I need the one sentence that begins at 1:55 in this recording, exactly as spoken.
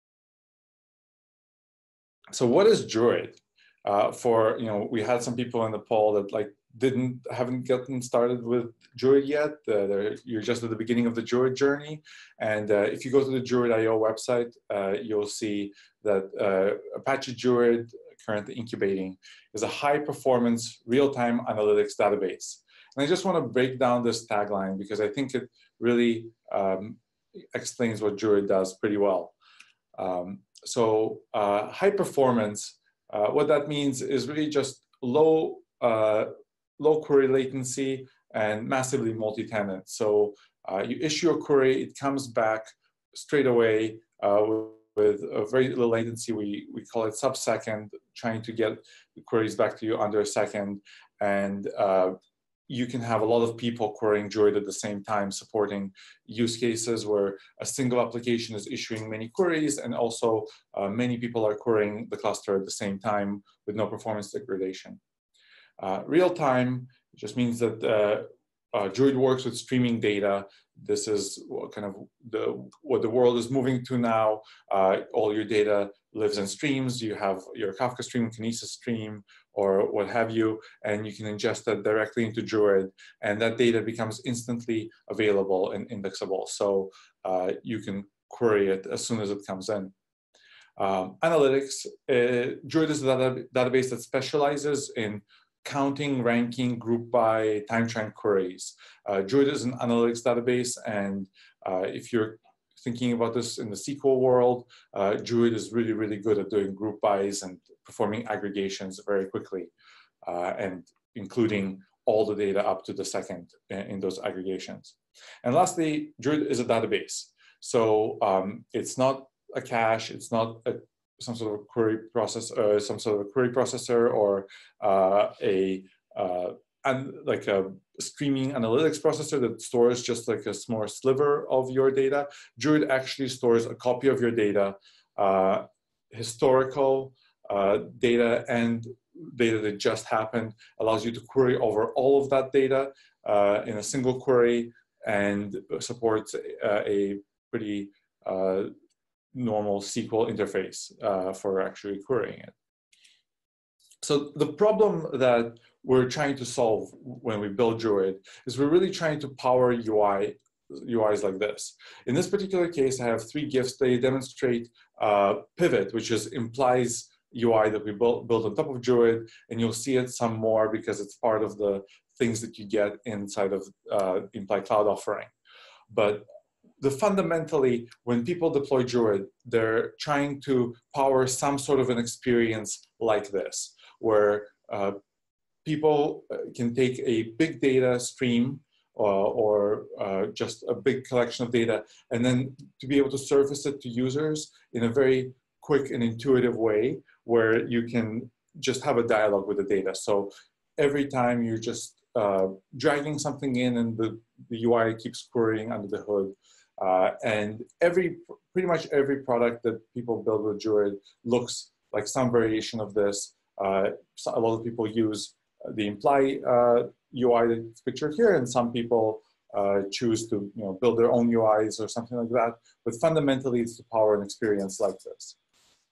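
And lastly, Druid is a database.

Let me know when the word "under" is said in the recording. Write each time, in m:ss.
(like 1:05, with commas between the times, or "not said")
0:49, 3:25.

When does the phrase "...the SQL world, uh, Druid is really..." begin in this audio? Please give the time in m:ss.
1:43.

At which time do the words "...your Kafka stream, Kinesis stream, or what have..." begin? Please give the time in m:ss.
1:17.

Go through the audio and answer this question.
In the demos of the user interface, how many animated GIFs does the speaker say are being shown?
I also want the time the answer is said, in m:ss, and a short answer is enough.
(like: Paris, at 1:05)
3, at 2:43.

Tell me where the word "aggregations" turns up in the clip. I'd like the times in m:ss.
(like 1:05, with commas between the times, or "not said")
1:48, 1:54.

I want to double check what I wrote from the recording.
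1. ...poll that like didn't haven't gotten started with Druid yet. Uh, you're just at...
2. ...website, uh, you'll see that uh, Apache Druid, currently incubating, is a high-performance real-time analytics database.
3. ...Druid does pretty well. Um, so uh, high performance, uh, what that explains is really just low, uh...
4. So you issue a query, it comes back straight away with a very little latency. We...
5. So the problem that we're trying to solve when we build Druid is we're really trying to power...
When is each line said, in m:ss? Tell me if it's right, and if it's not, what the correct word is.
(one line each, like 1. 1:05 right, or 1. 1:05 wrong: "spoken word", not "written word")
1. 0:05 right
2. 0:13 right
3. 0:28 wrong: "means", not "explains"
4. 0:39 right
5. 2:34 right.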